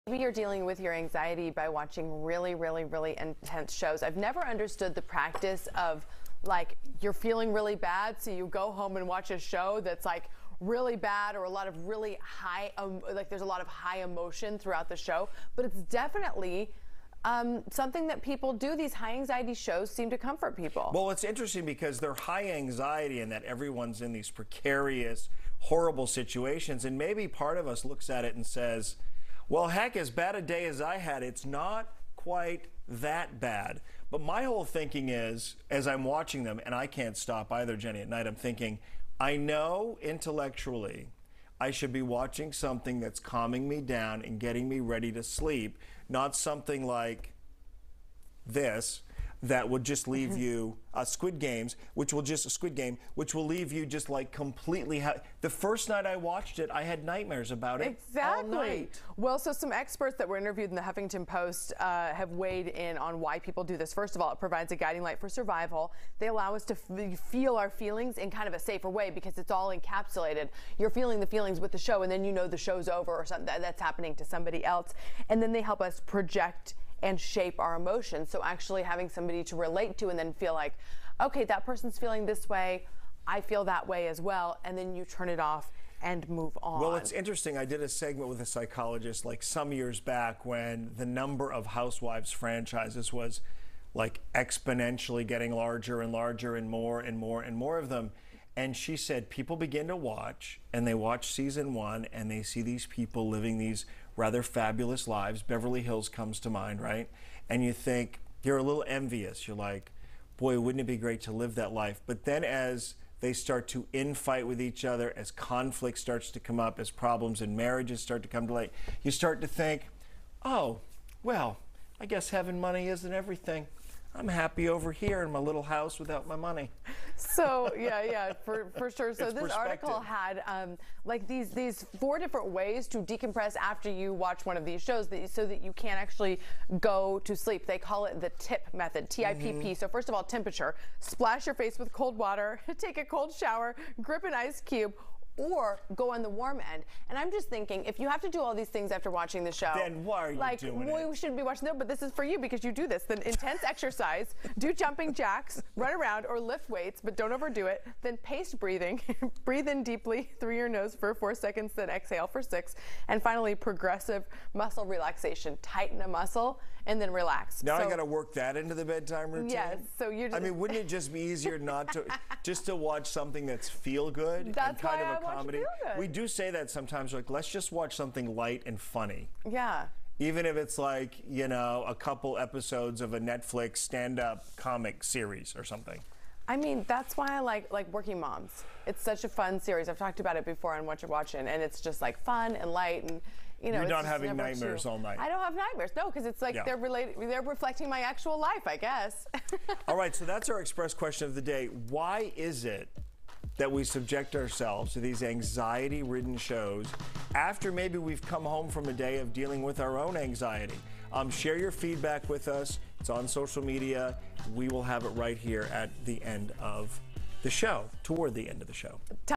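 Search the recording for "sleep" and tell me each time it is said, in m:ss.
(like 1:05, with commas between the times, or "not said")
0:45, 2:17.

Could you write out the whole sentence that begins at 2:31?
shouldn't be watching them, but this is for you because you do this.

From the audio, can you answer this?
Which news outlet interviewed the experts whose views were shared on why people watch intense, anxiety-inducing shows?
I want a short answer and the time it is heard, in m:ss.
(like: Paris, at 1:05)
Huffington Post, at 1:00.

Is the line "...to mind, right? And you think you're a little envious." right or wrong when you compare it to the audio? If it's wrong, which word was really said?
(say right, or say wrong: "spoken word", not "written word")
right.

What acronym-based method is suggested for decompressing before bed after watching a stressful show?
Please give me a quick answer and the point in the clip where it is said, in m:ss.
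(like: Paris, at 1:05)
TIP method, at 2:18.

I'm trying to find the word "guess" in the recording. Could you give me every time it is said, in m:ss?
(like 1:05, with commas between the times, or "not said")
2:02, 3:18.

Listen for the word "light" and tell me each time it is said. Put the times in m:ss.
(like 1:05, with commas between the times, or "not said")
1:05, 1:58, 2:58, 3:12.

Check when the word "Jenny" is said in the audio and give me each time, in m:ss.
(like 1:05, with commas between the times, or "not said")
0:37.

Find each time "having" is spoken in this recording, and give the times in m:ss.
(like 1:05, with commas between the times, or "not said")
1:18, 2:02, 3:14.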